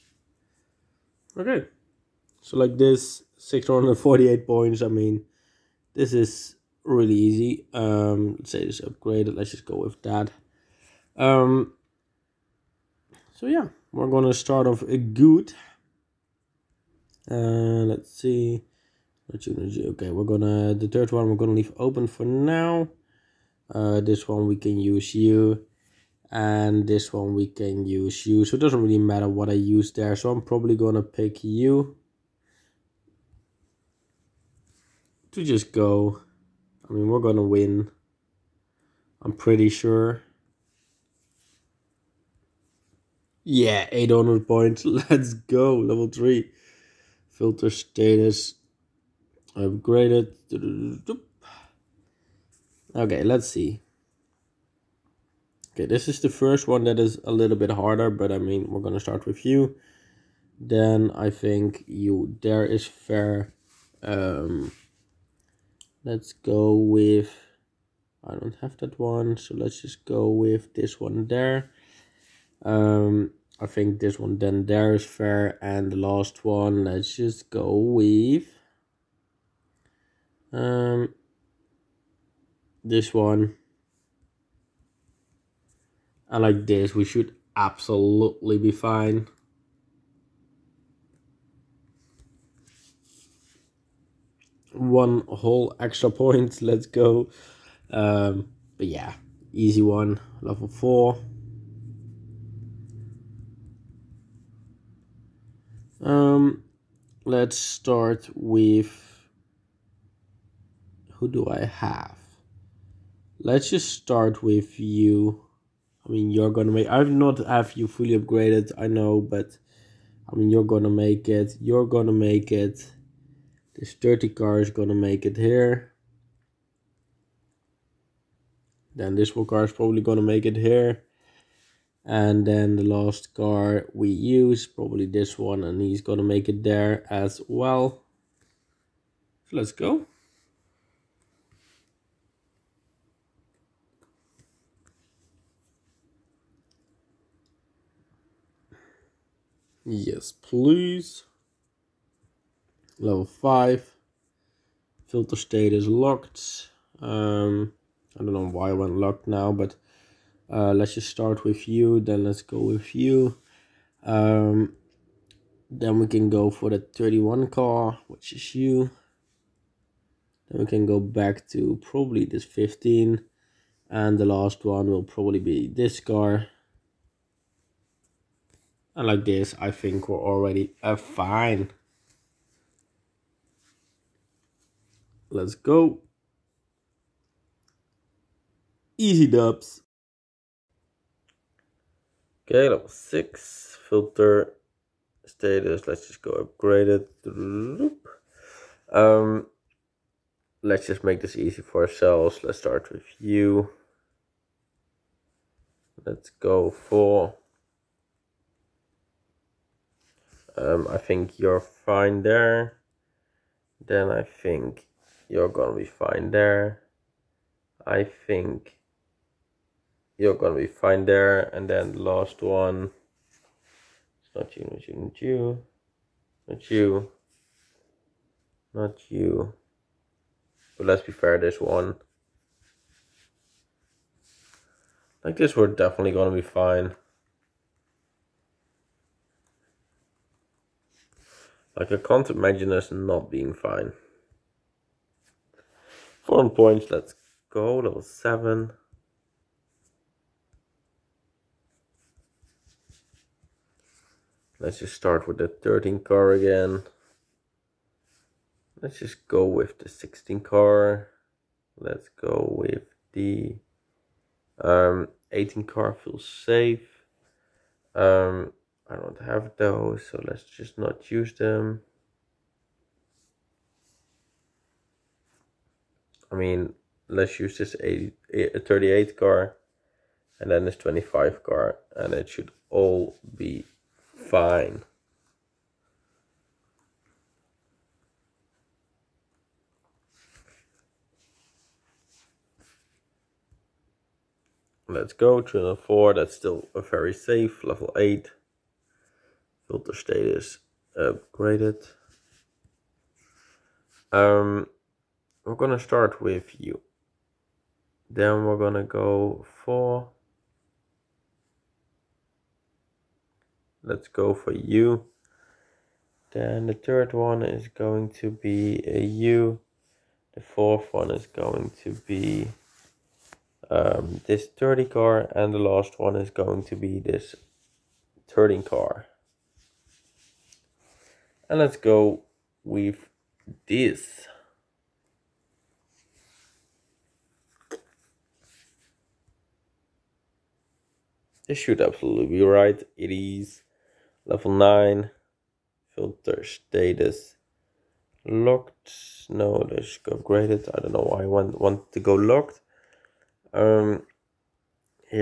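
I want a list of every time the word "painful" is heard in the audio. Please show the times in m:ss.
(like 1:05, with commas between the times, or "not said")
not said.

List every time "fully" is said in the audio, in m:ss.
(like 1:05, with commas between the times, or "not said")
1:57.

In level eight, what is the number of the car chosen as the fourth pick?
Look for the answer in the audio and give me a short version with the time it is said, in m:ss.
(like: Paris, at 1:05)
30, at 5:24.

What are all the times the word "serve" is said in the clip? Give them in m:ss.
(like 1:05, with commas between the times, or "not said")
not said.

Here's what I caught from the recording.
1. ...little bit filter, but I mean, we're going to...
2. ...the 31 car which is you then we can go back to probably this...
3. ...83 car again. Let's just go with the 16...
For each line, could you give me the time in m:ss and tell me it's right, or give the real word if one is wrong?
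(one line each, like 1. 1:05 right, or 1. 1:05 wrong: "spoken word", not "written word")
1. 0:57 wrong: "harder", not "filter"
2. 2:46 right
3. 4:15 wrong: "13", not "83".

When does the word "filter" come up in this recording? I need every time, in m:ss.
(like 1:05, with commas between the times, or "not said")
0:47, 2:35, 3:13, 4:59, 5:45.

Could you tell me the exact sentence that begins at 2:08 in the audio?
Then this car is probably gonna make it here.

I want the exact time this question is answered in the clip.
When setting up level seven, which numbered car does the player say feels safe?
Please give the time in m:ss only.
4:25.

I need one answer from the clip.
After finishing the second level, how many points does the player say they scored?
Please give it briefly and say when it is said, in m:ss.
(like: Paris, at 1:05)
800, at 0:43.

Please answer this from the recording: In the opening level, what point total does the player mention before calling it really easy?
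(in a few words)
648.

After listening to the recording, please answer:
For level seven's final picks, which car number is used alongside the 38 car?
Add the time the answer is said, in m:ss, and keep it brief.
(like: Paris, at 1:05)
25, at 4:40.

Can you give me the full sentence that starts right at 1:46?
Um, let's start with who do I have?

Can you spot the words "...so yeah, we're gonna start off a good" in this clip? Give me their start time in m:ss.
0:13.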